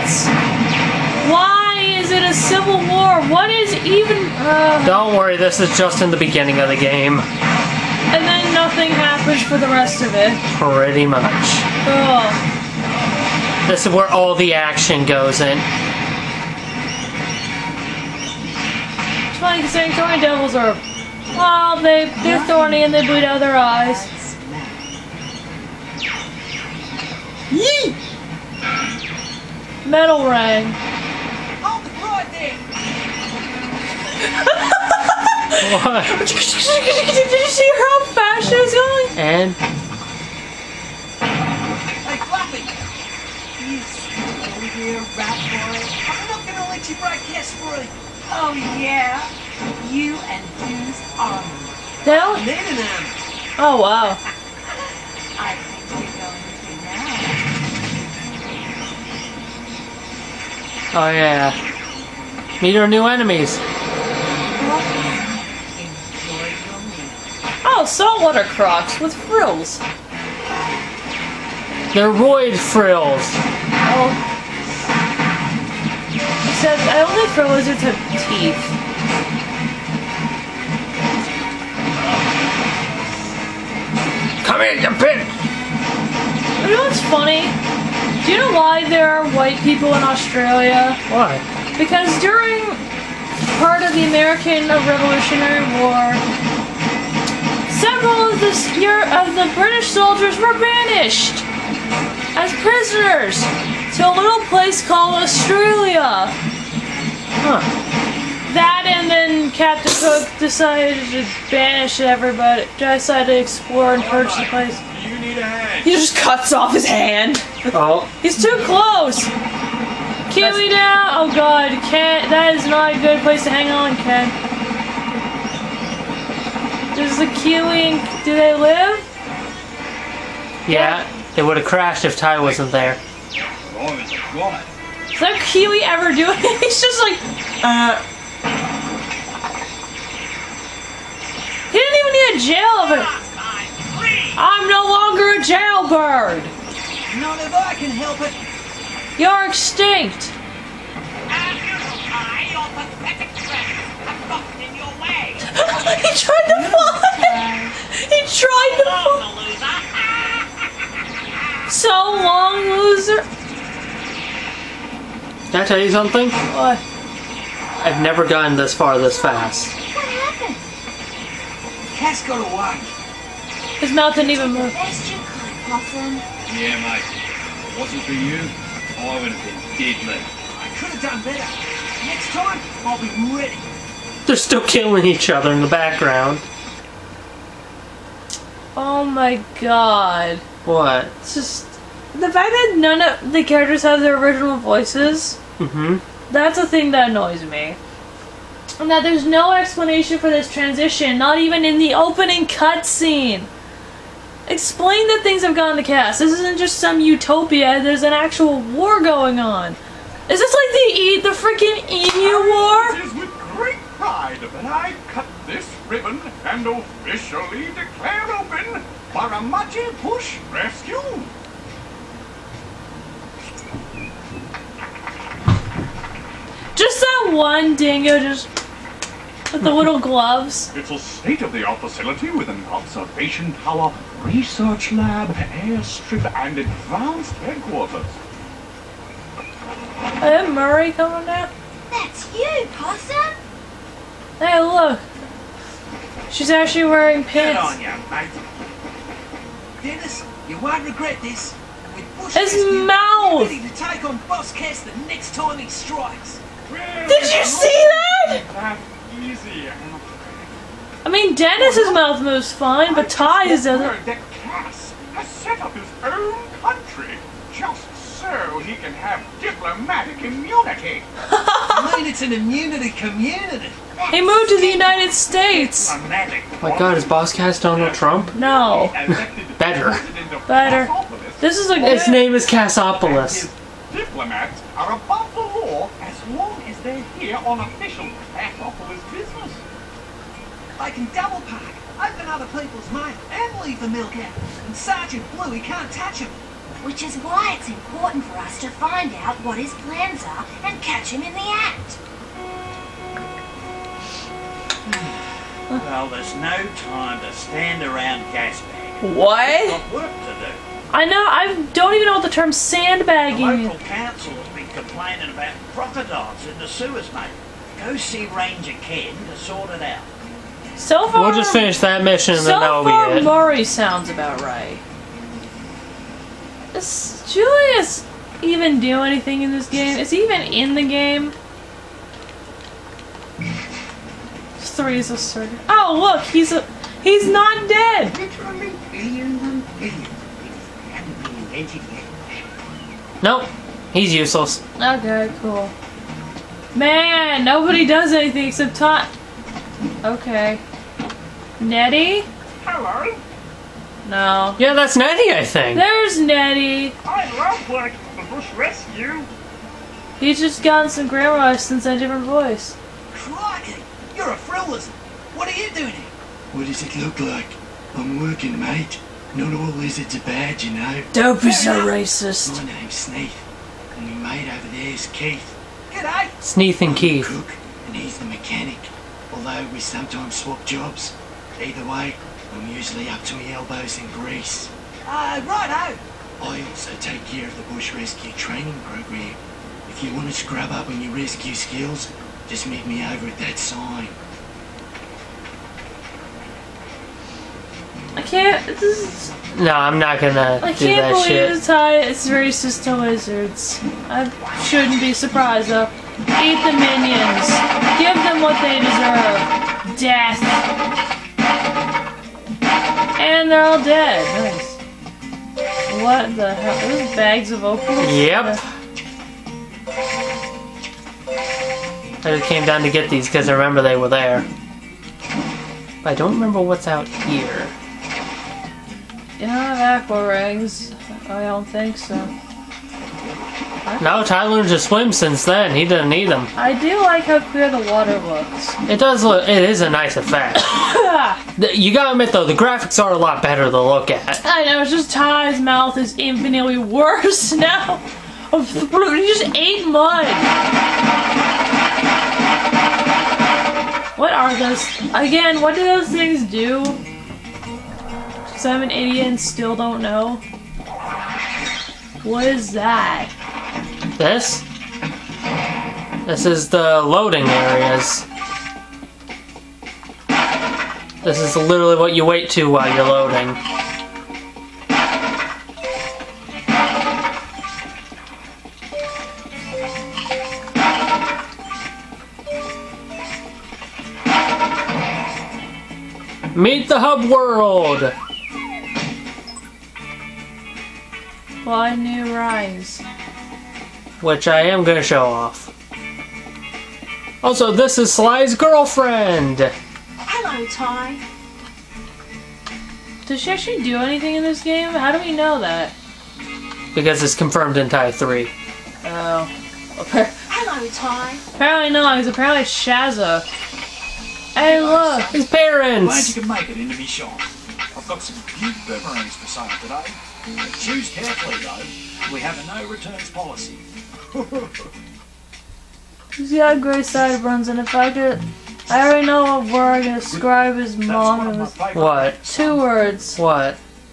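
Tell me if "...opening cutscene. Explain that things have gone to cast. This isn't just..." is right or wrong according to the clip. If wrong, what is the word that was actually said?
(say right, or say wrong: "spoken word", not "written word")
right.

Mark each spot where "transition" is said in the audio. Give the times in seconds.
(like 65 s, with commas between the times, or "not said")
200 s.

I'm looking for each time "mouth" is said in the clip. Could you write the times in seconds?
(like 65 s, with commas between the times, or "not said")
173 s, 252 s, 261 s, 445 s.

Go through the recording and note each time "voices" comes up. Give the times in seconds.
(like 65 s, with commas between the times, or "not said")
194 s, 362 s.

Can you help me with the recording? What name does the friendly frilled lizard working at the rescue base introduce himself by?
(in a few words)
Snaith.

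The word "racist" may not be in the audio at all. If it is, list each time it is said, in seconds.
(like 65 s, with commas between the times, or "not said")
371 s, 402 s.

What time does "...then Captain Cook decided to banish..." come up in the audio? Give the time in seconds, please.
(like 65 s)
109 s.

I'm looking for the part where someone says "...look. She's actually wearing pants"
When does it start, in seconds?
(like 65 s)
244 s.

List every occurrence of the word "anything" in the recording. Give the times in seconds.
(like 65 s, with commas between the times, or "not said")
329 s, 348 s, 503 s.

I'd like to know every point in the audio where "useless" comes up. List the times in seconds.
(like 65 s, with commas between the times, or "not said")
344 s.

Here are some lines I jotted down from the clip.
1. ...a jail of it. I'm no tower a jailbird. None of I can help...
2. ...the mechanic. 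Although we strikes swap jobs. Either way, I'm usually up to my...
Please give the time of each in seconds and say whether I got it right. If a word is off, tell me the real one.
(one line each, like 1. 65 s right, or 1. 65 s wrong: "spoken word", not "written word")
1. 142 s wrong: "longer", not "tower"
2. 378 s wrong: "sometimes", not "strikes".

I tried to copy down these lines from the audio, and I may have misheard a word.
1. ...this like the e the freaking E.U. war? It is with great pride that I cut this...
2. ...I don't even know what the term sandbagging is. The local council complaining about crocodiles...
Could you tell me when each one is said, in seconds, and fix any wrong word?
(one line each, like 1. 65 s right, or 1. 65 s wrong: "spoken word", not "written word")
1. 210 s right
2. 311 s right.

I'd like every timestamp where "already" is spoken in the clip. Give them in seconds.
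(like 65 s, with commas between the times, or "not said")
529 s.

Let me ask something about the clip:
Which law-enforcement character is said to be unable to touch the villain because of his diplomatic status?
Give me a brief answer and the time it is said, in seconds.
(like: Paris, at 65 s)
Sergeant Bluey, at 294 s.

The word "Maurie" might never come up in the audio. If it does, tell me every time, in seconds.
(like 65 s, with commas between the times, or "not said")
240 s, 323 s.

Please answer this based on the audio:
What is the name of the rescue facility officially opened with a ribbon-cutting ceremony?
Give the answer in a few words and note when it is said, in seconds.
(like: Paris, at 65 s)
Burramudgee Bush Rescue, at 219 s.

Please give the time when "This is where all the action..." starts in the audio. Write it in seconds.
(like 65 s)
13 s.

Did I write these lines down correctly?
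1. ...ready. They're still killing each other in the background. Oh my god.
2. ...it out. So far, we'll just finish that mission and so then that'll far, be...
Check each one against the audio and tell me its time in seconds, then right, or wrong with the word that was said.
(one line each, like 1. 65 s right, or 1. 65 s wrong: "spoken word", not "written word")
1. 183 s right
2. 319 s right.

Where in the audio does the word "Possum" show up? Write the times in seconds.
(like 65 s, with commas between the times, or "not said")
175 s, 242 s.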